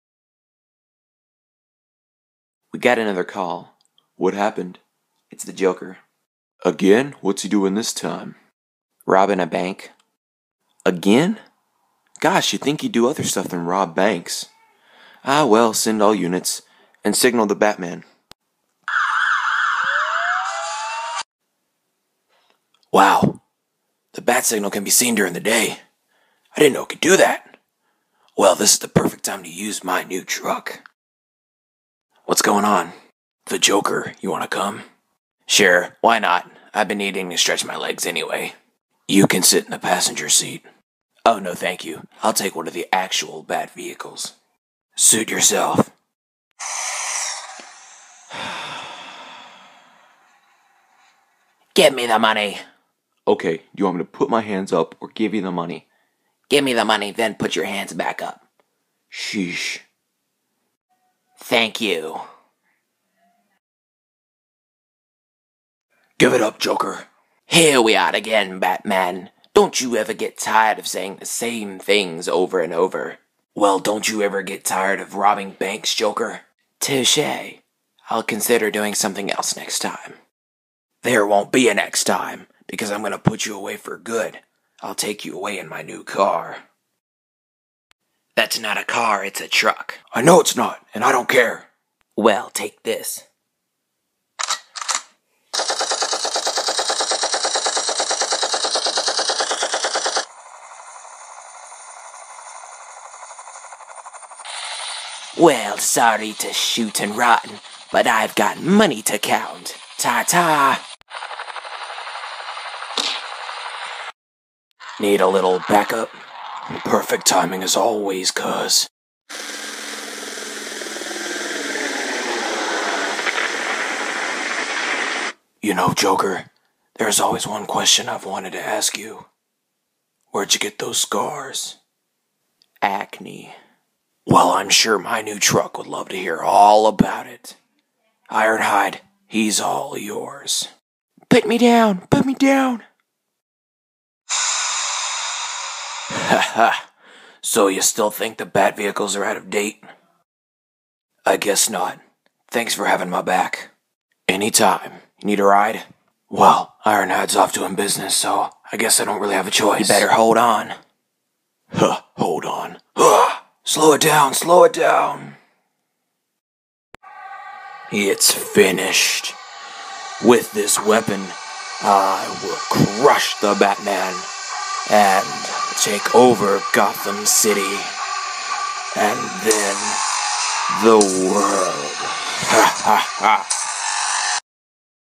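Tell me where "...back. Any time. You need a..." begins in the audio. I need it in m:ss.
2:33.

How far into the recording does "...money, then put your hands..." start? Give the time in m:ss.
0:56.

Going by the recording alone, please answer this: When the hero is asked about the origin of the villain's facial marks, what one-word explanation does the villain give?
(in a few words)
Acne.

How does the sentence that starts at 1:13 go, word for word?
Well, don't you ever get tired of robbing banks, Joker?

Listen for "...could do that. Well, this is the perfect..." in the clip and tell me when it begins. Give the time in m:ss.
0:26.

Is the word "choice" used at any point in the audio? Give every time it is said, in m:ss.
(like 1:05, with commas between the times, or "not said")
2:39.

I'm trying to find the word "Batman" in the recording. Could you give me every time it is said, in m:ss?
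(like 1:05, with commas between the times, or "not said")
0:17, 1:08, 2:53.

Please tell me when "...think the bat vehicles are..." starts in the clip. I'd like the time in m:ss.
2:28.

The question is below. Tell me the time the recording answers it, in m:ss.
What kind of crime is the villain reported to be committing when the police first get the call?
0:09.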